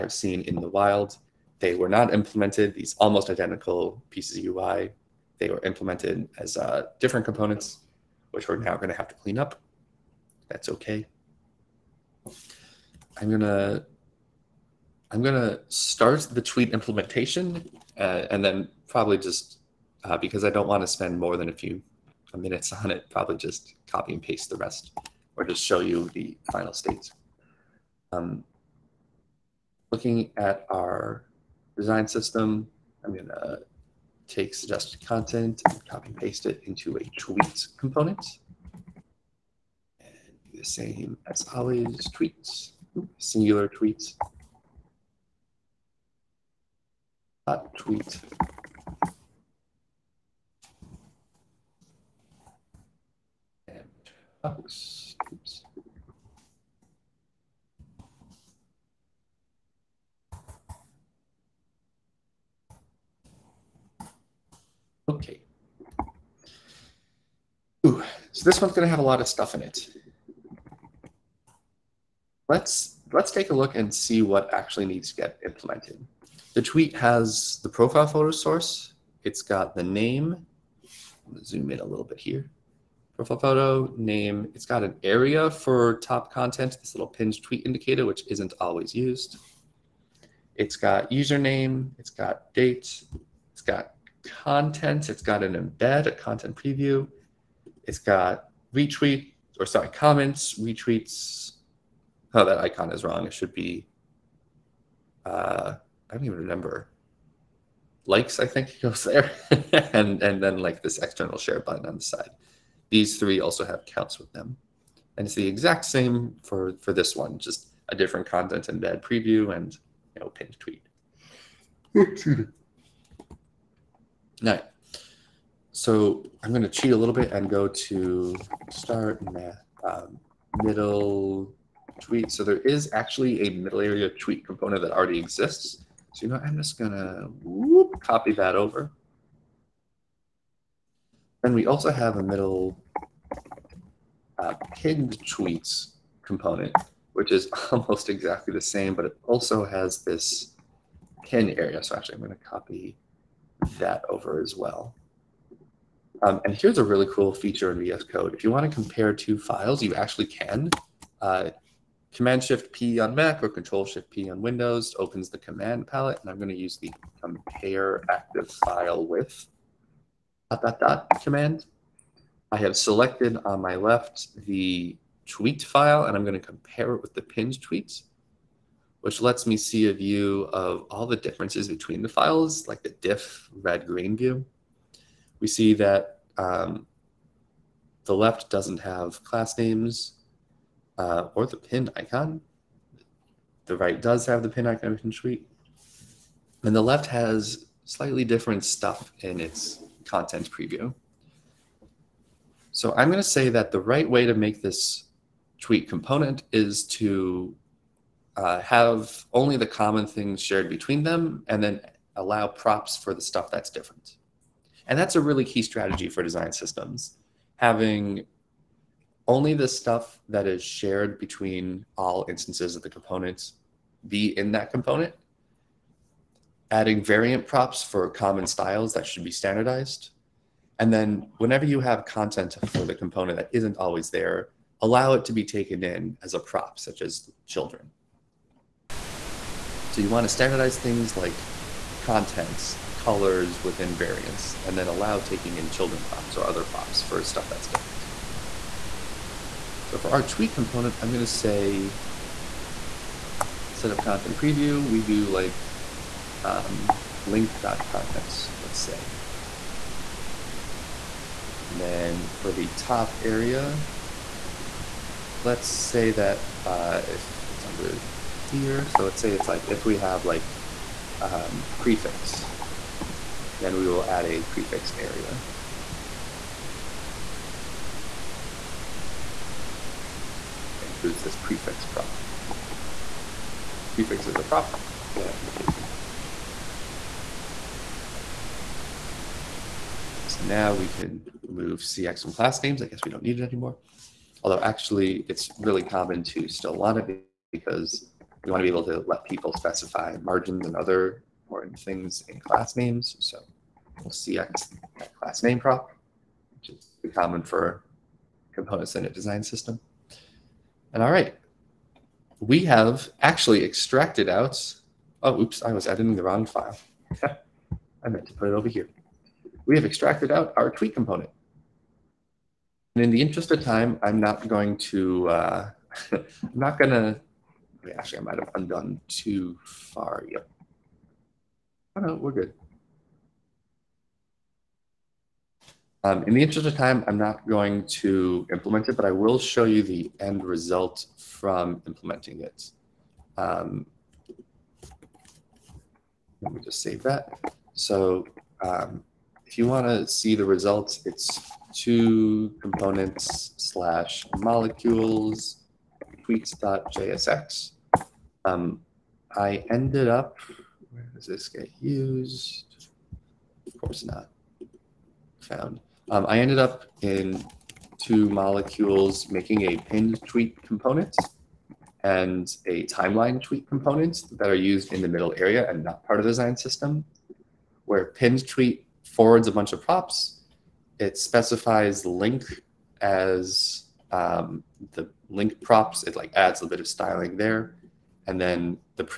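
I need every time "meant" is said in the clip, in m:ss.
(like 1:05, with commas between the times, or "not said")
5:18.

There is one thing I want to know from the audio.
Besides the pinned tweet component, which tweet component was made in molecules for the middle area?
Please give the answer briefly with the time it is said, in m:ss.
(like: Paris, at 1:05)
timeline tweet, at 6:12.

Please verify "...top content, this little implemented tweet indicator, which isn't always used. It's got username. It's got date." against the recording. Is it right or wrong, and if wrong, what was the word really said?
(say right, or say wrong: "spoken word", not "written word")
wrong: "pinned", not "implemented".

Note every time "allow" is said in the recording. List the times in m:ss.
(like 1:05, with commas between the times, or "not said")
3:32, 3:54, 4:04.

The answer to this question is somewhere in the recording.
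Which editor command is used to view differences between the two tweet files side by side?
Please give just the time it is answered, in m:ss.
2:47.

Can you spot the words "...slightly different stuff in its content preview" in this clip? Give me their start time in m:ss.
3:17.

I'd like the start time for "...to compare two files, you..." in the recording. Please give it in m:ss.
2:38.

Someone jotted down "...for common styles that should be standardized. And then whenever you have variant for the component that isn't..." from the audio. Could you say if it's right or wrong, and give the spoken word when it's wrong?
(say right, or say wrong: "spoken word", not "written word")
wrong: "content", not "variant".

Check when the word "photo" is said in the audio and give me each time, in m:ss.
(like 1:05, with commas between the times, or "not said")
1:18, 1:23.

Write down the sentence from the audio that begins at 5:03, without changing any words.
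So we'll CX that class name prop, which is common for components in a design system.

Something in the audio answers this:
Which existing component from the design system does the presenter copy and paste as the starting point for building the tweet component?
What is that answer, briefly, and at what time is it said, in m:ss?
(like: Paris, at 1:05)
suggested content, at 0:34.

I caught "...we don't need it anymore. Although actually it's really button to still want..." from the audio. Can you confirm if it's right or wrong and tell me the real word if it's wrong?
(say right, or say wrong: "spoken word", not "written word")
wrong: "common", not "button".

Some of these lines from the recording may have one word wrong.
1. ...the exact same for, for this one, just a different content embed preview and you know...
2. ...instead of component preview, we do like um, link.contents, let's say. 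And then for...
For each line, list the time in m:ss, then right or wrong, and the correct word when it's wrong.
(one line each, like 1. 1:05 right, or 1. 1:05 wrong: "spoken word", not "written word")
1. 1:55 right
2. 4:13 wrong: "content", not "component".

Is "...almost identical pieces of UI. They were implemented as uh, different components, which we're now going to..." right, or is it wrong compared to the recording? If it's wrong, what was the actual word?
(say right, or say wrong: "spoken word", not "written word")
right.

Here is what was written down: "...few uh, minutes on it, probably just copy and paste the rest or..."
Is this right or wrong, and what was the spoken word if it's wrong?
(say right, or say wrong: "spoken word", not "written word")
right.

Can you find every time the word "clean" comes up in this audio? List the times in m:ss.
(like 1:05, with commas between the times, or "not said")
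0:09.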